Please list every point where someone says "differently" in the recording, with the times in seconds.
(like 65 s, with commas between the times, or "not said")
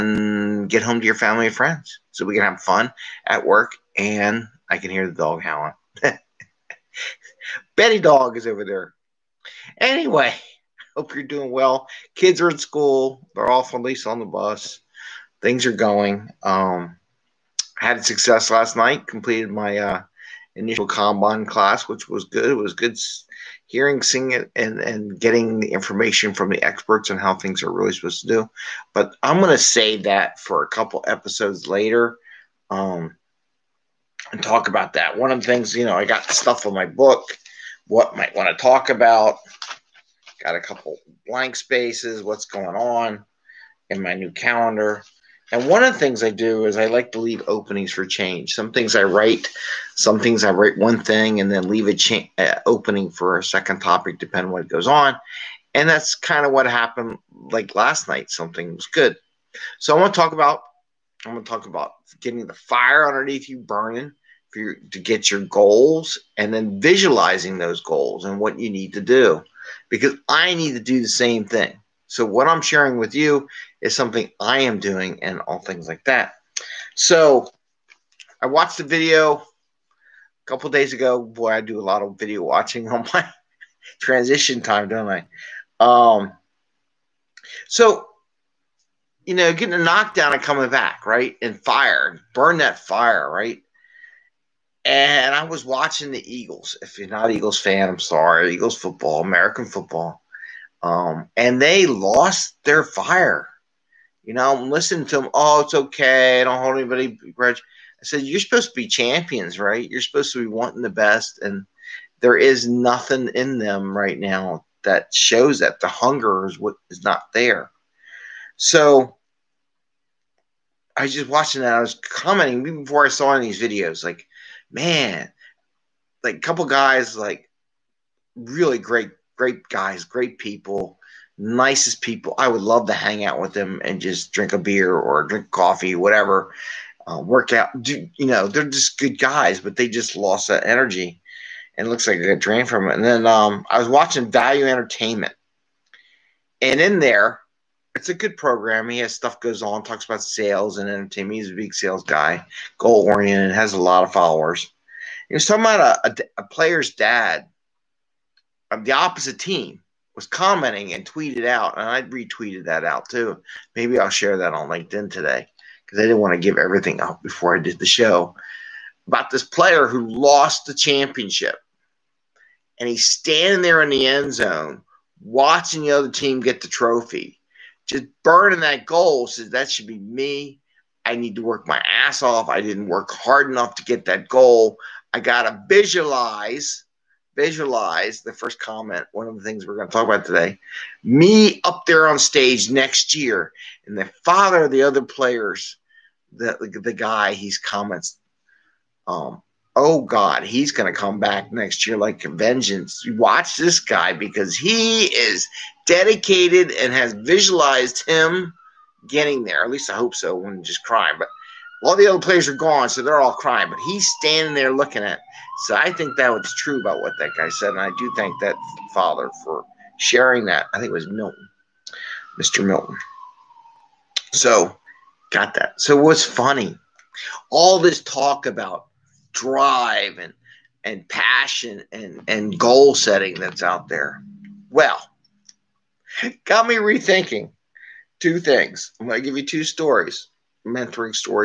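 not said.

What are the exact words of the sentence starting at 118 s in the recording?
So I was just watching that.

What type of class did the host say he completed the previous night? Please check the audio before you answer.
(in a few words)
Kanban.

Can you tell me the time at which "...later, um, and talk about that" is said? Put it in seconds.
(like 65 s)
31 s.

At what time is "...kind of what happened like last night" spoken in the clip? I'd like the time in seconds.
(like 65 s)
56 s.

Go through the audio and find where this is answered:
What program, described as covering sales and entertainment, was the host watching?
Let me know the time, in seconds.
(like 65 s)
144 s.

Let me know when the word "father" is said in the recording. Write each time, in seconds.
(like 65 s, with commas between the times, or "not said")
194 s, 218 s.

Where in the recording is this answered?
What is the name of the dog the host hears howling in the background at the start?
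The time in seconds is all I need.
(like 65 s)
7 s.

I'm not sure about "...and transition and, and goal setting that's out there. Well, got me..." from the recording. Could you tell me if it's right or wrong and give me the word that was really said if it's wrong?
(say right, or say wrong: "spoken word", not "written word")
wrong: "passion", not "transition".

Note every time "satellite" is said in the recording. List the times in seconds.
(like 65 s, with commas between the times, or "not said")
not said.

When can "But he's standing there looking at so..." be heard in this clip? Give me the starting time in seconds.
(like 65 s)
213 s.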